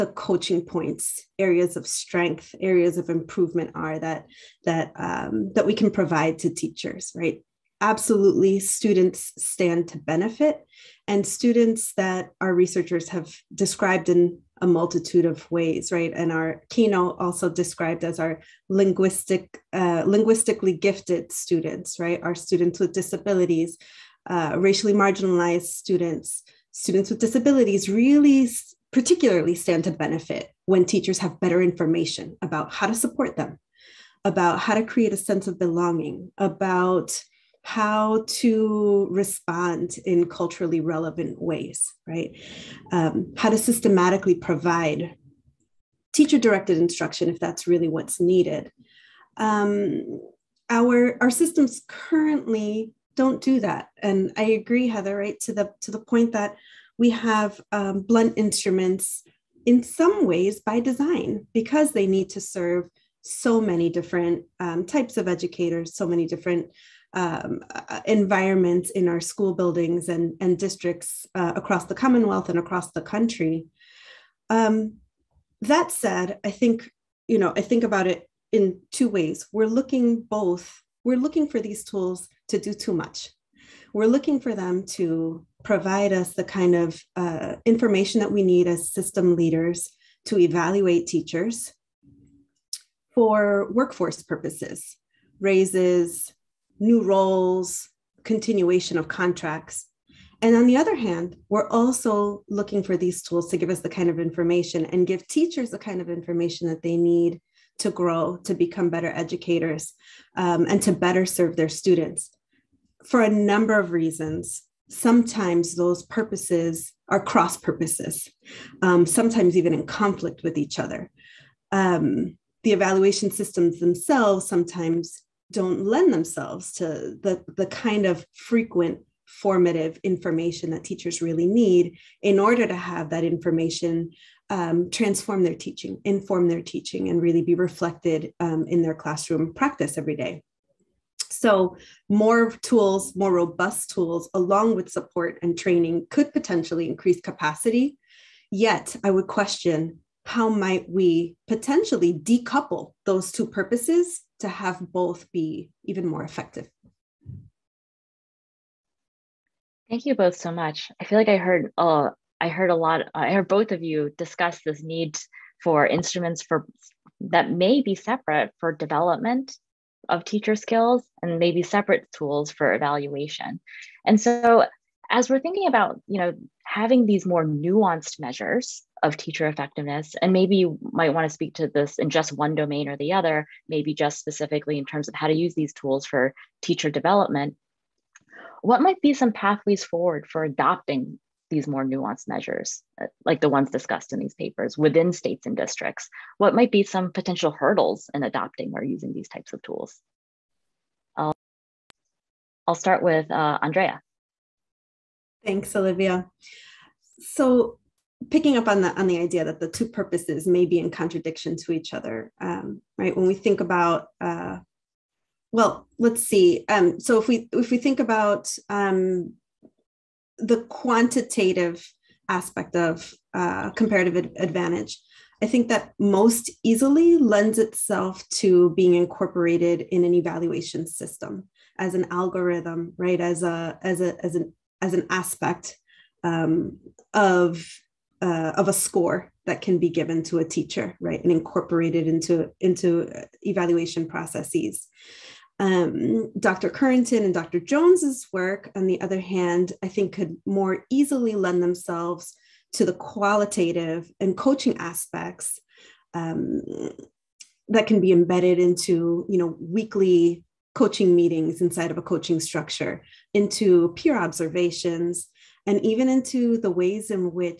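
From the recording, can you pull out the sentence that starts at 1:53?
For a number of reasons, sometimes those purposes are cross purposes, um, sometimes even in conflict with each other.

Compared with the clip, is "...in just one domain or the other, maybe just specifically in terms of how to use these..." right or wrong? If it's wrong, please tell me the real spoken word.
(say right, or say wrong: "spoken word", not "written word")
right.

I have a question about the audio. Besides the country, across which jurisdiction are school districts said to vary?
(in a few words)
the Commonwealth.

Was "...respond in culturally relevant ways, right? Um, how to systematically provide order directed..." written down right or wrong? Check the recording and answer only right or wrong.
wrong.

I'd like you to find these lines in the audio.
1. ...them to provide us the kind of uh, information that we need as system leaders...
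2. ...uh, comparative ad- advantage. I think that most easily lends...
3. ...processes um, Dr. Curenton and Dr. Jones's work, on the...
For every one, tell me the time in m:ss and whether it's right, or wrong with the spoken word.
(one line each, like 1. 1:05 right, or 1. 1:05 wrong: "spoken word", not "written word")
1. 1:24 right
2. 3:43 right
3. 4:04 right.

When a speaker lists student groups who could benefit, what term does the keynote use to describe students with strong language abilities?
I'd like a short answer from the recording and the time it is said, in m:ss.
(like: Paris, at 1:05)
linguistically gifted, at 0:20.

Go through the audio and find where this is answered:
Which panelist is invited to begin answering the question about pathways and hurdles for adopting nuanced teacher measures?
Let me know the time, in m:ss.
3:23.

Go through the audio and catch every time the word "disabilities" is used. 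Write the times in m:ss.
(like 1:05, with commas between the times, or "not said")
0:22, 0:27.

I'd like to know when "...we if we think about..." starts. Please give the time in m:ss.
3:37.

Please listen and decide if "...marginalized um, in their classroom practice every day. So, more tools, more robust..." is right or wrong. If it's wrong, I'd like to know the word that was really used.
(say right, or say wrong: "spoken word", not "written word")
wrong: "reflected", not "marginalized".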